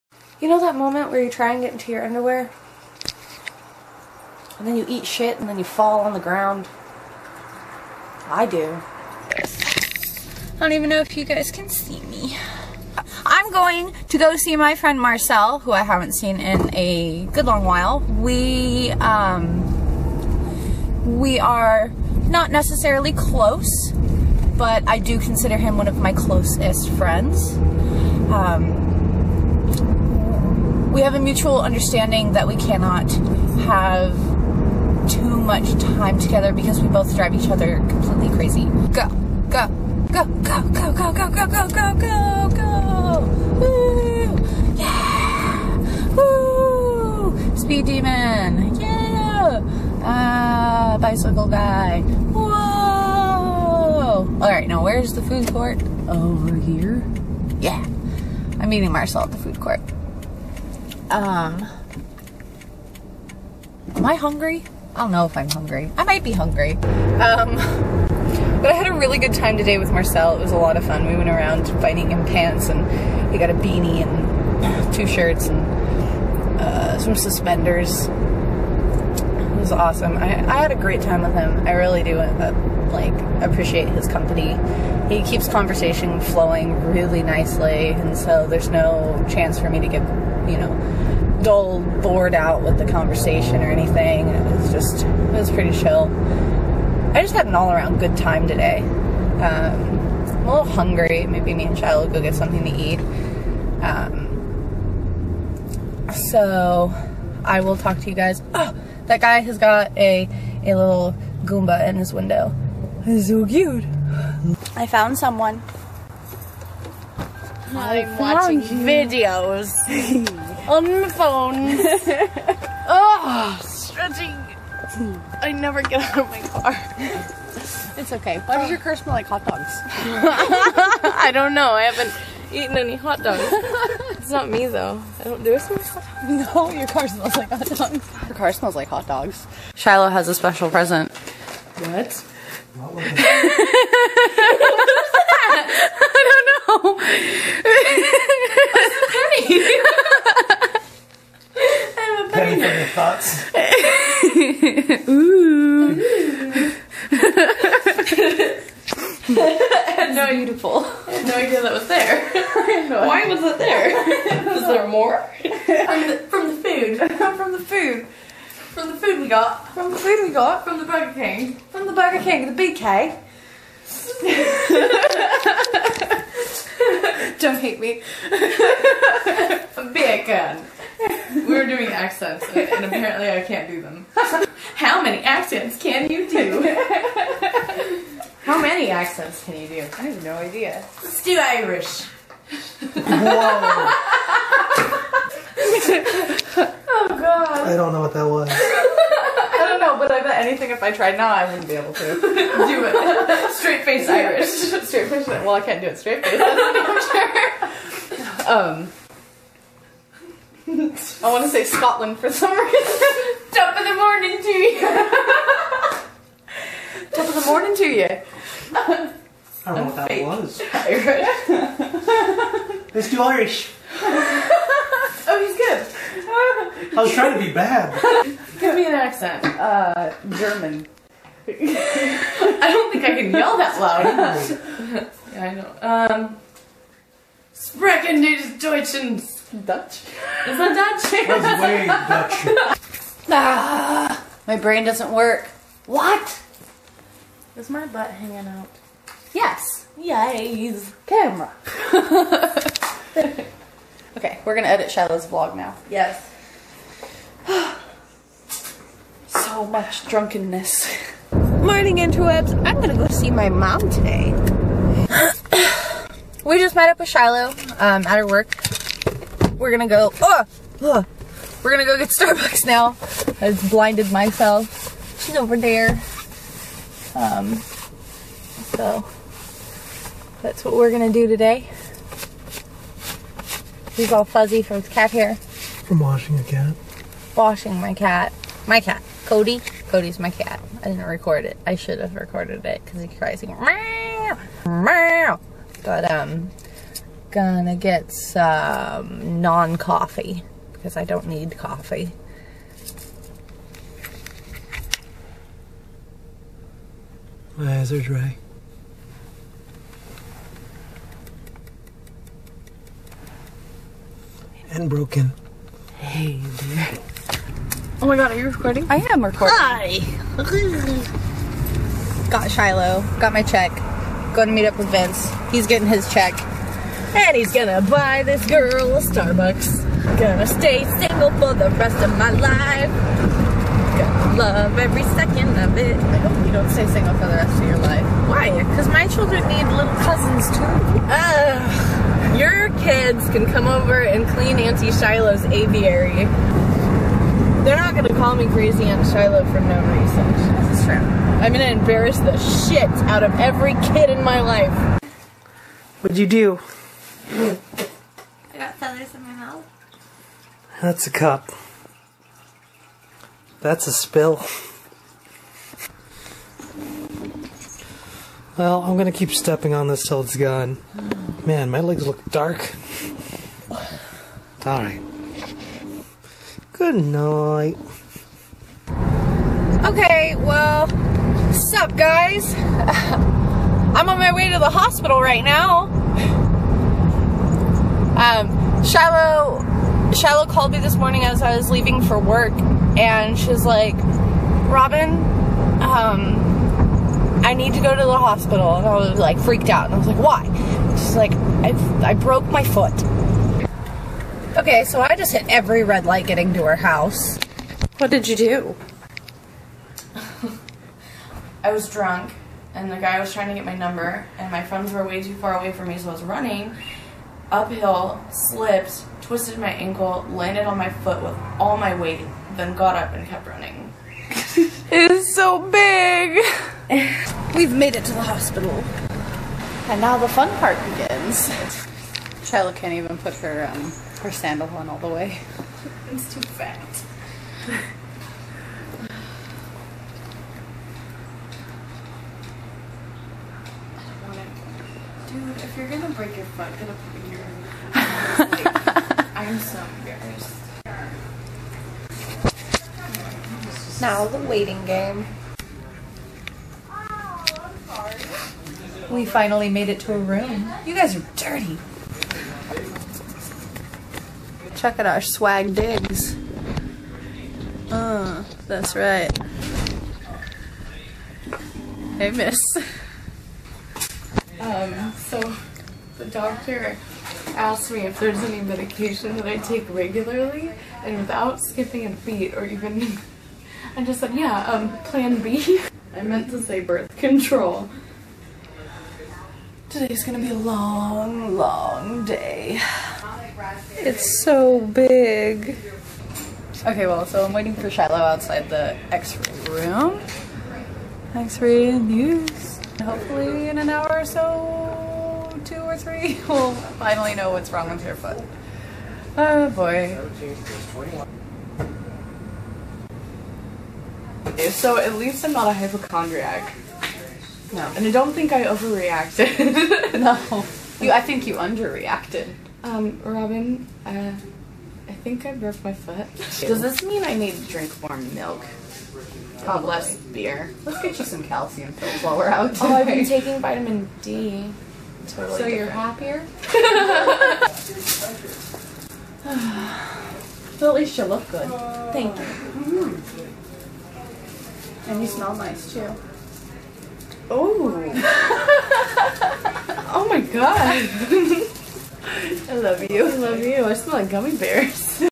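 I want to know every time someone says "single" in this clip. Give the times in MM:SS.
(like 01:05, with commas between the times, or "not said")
05:30, 05:36.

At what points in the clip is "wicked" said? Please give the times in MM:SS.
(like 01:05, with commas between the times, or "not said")
not said.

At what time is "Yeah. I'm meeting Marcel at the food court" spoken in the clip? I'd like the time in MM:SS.
00:57.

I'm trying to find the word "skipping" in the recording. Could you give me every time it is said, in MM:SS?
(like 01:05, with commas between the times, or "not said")
08:01.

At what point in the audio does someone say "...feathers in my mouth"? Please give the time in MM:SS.
05:58.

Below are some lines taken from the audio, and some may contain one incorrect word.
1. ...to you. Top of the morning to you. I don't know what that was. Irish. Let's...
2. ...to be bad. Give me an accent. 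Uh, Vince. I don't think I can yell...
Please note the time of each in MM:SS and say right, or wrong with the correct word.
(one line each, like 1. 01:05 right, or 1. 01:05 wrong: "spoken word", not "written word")
1. 03:34 right
2. 03:47 wrong: "German", not "Vince".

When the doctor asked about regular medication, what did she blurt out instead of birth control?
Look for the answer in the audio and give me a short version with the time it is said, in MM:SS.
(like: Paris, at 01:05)
Plan B, at 08:05.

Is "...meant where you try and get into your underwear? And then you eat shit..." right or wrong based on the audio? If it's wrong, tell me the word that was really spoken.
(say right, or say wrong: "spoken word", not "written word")
wrong: "moment", not "meant".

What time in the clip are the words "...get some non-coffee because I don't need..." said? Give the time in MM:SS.
04:57.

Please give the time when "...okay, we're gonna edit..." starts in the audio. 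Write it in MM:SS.
04:14.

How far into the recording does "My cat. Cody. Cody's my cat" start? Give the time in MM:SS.
04:48.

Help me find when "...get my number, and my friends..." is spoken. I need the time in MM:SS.
06:53.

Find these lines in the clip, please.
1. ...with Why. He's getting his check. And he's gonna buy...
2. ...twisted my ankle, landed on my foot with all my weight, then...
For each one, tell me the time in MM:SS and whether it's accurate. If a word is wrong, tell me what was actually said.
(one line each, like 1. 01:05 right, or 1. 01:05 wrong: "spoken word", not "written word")
1. 05:24 wrong: "Vince", not "Why"
2. 06:59 right.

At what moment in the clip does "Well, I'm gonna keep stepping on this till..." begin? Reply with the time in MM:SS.
06:08.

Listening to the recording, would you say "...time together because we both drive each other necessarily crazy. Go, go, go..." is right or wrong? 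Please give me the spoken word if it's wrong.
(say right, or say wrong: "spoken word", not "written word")
wrong: "completely", not "necessarily".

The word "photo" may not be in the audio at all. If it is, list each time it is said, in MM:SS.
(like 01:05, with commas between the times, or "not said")
not said.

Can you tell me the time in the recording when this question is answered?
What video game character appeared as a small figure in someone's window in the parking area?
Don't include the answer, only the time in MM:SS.
01:51.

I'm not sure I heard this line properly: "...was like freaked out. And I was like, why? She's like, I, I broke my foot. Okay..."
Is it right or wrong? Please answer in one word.
right.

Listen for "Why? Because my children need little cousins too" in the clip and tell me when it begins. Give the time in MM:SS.
05:38.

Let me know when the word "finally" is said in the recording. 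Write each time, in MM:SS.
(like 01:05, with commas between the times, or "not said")
07:39, 08:26.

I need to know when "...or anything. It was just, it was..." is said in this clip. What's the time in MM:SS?
01:33.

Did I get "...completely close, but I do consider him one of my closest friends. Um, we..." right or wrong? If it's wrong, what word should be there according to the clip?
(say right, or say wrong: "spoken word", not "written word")
wrong: "necessarily", not "completely".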